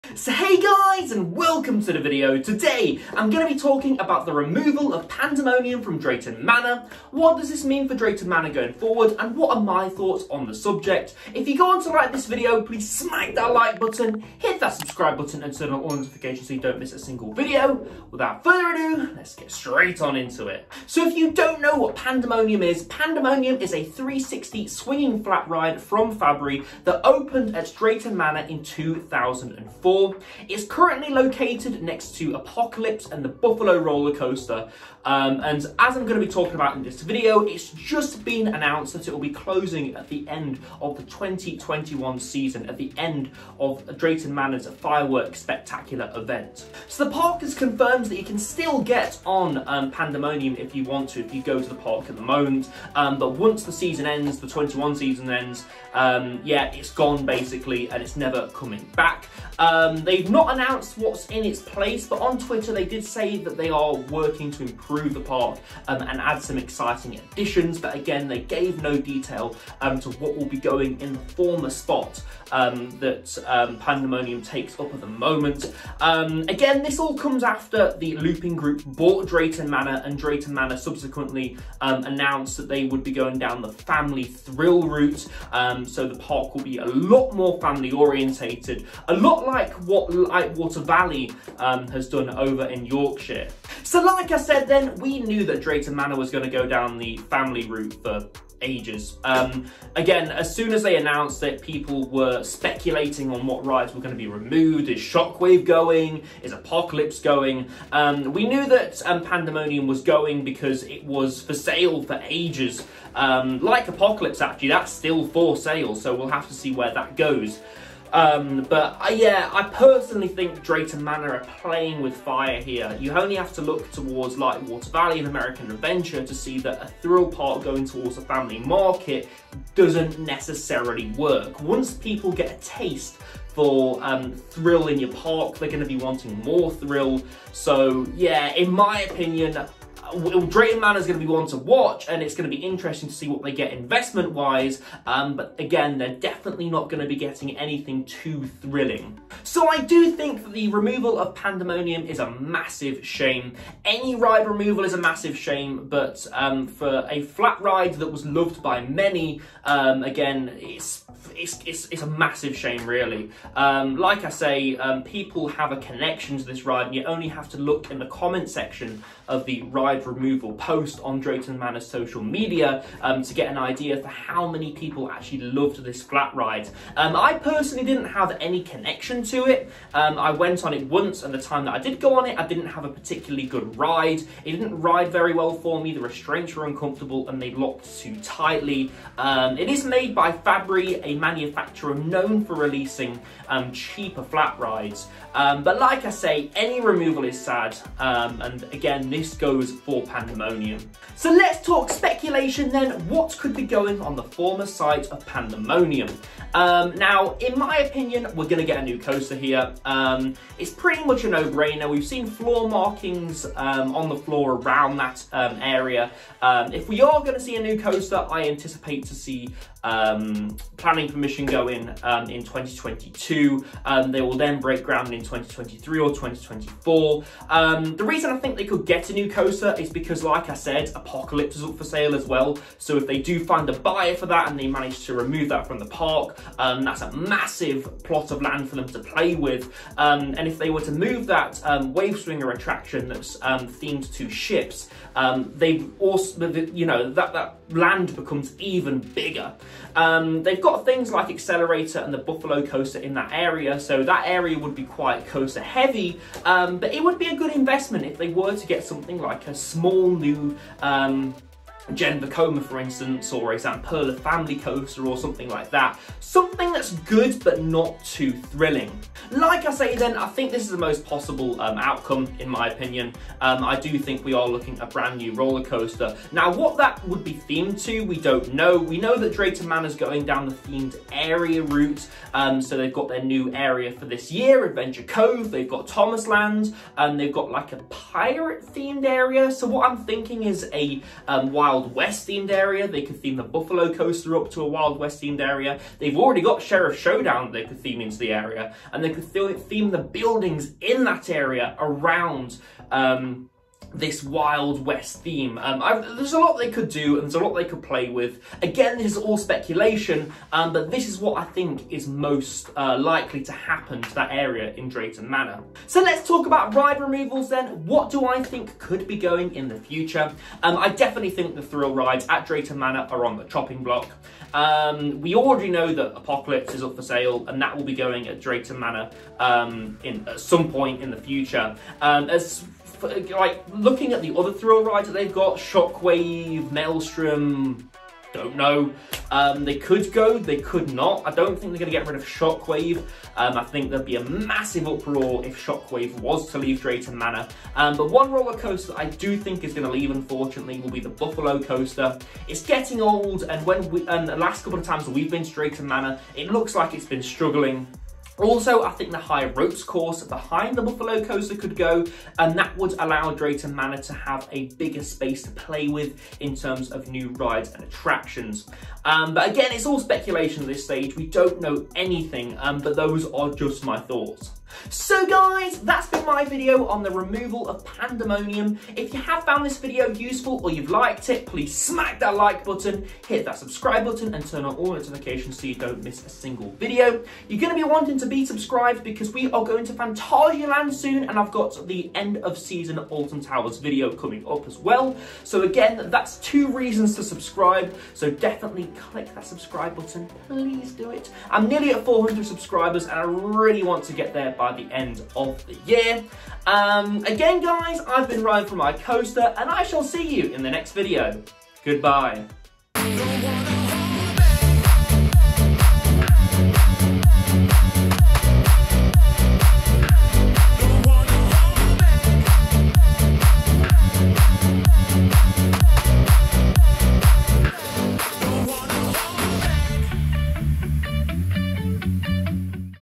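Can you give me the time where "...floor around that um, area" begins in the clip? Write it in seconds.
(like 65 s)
214 s.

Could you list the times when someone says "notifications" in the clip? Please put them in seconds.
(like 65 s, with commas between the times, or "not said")
15 s, 384 s.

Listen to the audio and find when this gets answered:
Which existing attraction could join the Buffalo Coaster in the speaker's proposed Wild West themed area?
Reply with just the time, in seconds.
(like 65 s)
296 s.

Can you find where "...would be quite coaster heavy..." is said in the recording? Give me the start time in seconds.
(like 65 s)
254 s.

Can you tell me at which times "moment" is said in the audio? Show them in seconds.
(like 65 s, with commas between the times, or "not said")
52 s, 75 s.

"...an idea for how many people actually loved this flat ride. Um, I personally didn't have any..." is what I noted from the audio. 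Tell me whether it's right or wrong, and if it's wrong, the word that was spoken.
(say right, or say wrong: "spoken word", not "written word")
right.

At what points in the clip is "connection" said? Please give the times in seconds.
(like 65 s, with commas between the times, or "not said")
165 s, 178 s.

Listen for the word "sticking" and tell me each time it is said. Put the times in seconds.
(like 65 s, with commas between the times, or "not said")
not said.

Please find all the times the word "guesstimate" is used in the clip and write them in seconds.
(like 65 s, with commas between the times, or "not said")
not said.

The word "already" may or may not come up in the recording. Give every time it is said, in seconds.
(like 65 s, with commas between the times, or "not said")
296 s, 325 s.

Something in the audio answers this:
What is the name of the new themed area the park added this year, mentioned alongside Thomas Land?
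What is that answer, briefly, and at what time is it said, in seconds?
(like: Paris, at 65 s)
Adventure Cove, at 284 s.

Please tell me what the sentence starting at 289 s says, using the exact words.
So what I'm thinking is a um, wild Wild West themed area.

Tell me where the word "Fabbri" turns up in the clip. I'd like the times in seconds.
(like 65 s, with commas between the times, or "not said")
26 s, 190 s.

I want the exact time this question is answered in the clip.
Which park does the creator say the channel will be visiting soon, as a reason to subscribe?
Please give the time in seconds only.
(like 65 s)
389 s.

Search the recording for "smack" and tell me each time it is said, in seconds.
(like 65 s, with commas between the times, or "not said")
12 s, 381 s.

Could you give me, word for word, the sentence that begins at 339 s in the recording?
Um, they could go, they could not.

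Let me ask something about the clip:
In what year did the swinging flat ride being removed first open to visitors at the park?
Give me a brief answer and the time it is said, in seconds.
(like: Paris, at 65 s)
2004, at 28 s.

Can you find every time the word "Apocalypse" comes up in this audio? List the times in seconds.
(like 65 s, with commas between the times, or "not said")
32 s, 106 s, 113 s, 230 s, 326 s.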